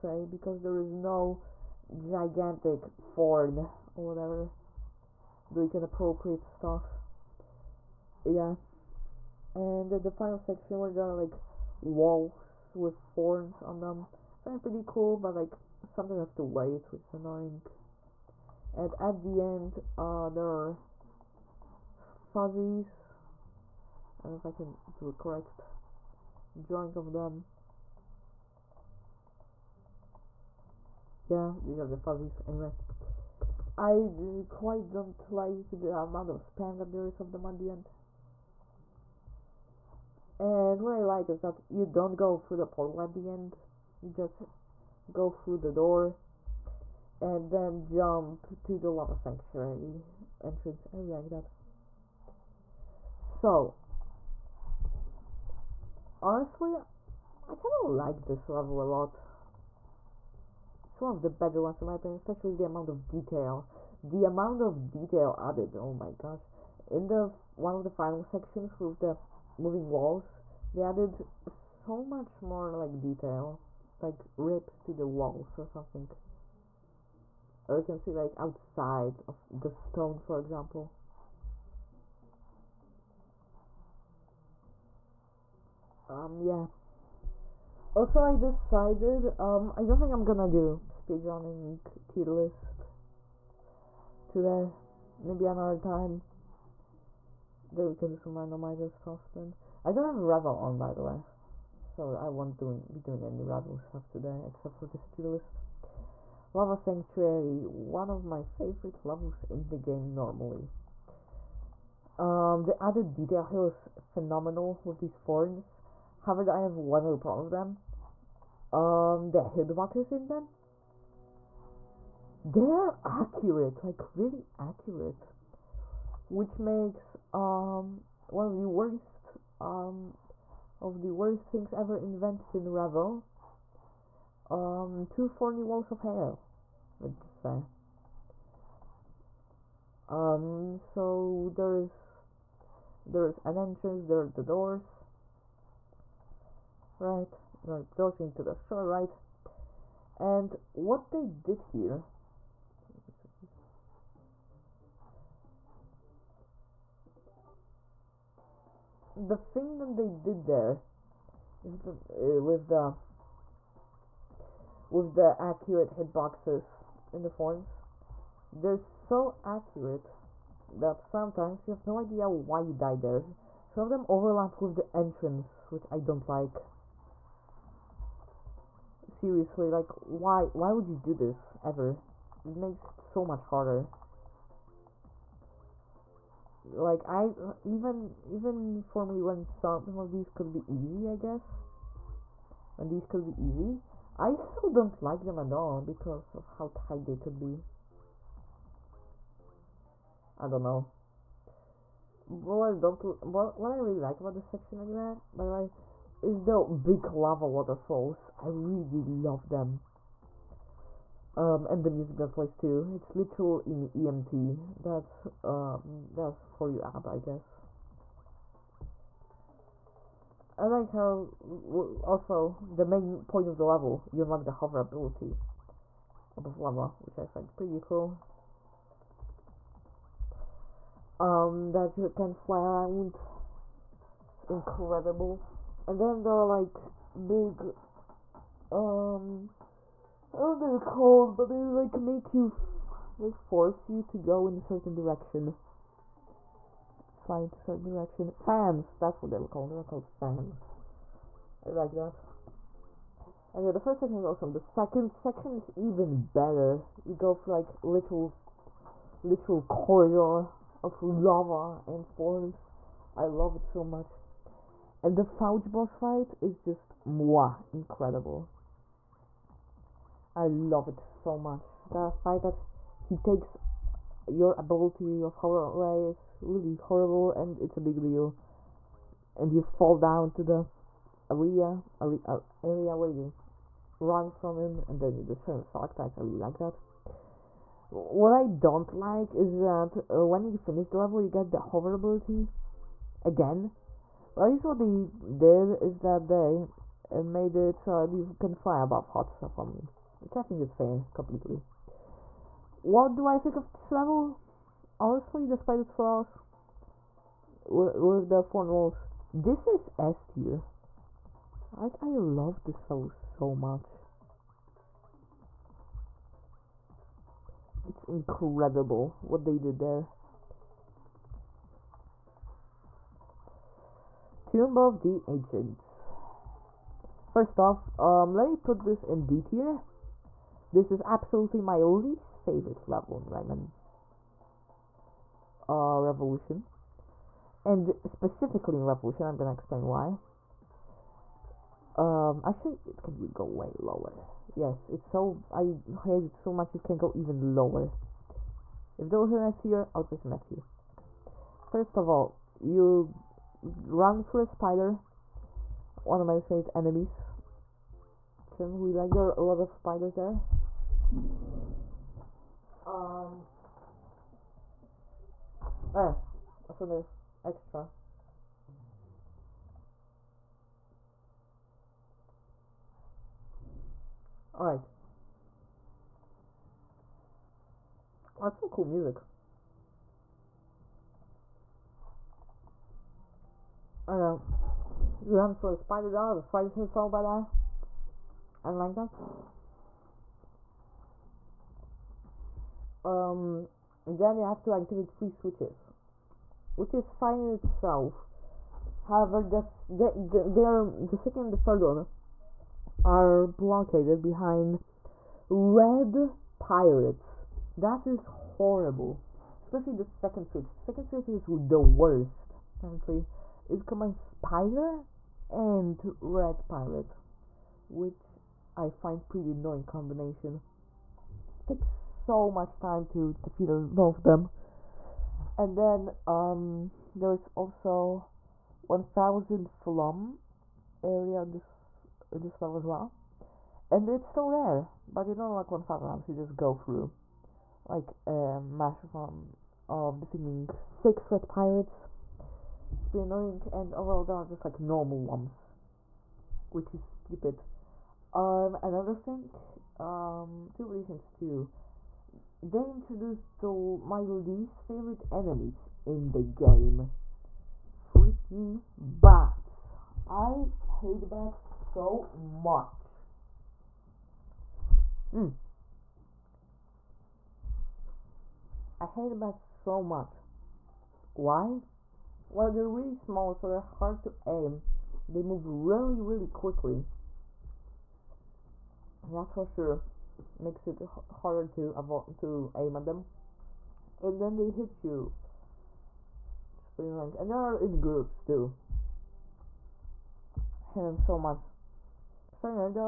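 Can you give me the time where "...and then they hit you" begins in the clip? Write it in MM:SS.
08:04.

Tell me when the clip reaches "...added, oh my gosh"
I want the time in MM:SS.
01:05.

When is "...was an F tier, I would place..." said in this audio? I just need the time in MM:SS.
05:49.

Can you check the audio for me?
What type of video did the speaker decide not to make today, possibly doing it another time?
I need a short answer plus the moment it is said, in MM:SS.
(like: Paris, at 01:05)
speedrunning tier list, at 01:30.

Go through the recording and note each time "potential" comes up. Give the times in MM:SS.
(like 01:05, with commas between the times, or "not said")
not said.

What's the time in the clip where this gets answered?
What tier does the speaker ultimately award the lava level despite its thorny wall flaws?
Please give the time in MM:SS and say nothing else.
05:09.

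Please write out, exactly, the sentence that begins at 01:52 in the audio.
Um, the added detail here is phenomenal with these thorns.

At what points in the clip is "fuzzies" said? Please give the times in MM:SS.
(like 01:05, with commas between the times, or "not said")
00:21, 00:31.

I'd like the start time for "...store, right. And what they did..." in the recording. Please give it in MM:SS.
02:28.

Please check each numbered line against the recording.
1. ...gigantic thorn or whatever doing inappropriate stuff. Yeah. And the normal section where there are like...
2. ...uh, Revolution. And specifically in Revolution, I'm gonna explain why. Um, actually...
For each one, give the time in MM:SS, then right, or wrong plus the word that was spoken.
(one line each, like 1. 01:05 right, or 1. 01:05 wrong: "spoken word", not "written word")
1. 00:01 wrong: "final", not "normal"
2. 05:35 right.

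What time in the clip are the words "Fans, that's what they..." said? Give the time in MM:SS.
04:08.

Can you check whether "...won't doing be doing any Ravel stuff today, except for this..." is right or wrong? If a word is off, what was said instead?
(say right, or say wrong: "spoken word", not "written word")
right.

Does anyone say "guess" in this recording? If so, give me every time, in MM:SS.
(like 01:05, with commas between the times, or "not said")
03:11, 03:37.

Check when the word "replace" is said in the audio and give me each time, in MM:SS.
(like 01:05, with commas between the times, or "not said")
not said.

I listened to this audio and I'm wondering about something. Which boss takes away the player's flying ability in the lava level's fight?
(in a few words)
Foutch.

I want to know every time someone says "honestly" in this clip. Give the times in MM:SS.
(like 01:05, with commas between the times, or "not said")
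00:56, 05:04.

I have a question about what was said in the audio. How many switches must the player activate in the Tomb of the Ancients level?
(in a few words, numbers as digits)
3.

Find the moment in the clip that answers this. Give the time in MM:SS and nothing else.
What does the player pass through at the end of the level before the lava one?
00:45.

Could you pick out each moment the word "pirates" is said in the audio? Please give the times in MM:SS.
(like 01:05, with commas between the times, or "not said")
06:46, 06:56, 07:21.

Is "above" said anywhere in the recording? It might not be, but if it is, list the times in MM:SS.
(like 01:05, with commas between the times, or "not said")
03:46, 04:58.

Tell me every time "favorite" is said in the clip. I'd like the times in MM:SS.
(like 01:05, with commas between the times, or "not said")
01:48, 05:32, 05:56, 07:34.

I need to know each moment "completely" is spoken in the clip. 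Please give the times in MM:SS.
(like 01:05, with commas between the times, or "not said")
05:01.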